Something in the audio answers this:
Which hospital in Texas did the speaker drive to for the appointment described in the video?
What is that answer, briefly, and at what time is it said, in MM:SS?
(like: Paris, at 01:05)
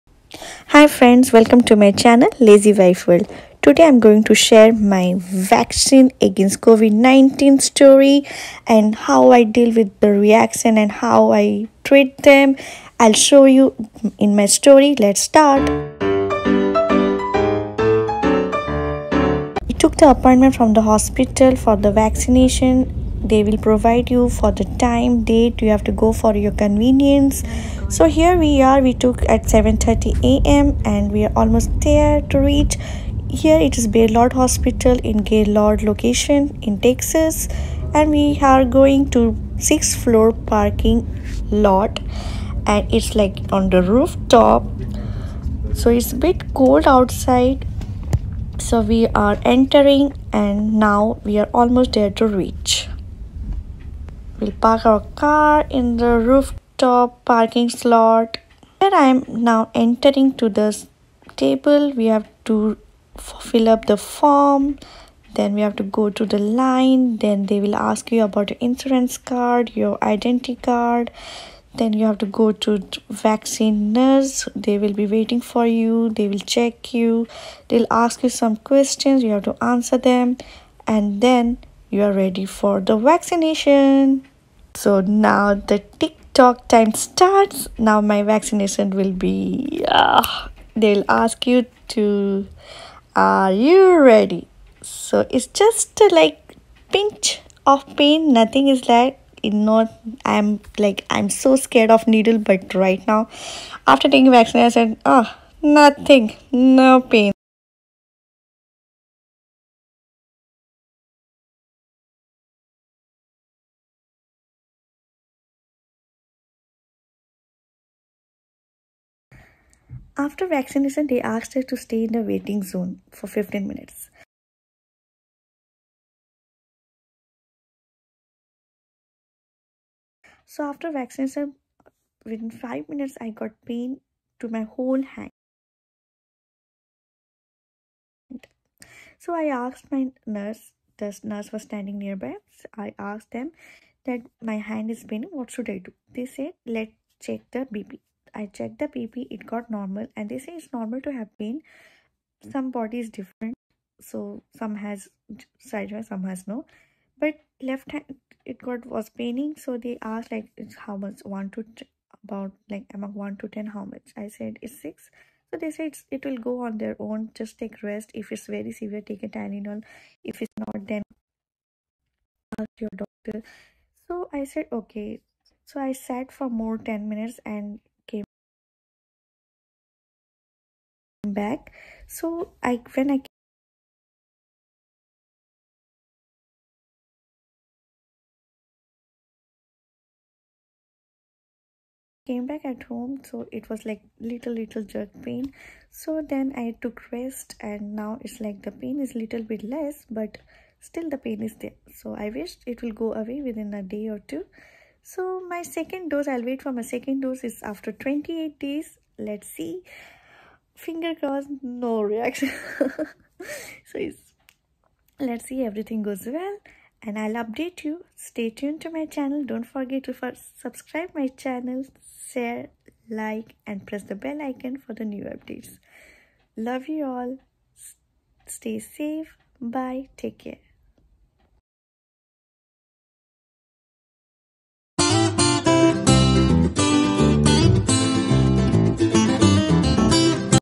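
Baylor, at 00:33.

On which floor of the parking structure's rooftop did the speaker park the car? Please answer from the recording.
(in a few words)
Sixth floor.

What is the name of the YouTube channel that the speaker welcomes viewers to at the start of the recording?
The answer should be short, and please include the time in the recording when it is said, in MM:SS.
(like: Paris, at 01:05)
Lazy Wife World, at 00:02.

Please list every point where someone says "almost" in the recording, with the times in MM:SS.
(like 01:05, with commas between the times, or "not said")
00:31, 00:51.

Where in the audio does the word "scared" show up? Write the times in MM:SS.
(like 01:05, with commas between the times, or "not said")
01:41.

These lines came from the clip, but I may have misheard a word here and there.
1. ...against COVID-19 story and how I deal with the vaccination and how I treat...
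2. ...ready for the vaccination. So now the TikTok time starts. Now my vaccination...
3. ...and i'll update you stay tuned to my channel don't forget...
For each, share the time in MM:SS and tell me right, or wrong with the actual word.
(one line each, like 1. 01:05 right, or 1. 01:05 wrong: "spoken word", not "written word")
1. 00:06 wrong: "reaction", not "vaccination"
2. 01:22 right
3. 03:37 right.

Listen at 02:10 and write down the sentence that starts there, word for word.
So after vaccination, within 5 minutes, I got pain to my whole hand.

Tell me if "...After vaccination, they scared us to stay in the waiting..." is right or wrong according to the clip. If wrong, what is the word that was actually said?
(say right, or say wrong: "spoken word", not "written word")
wrong: "asked", not "scared".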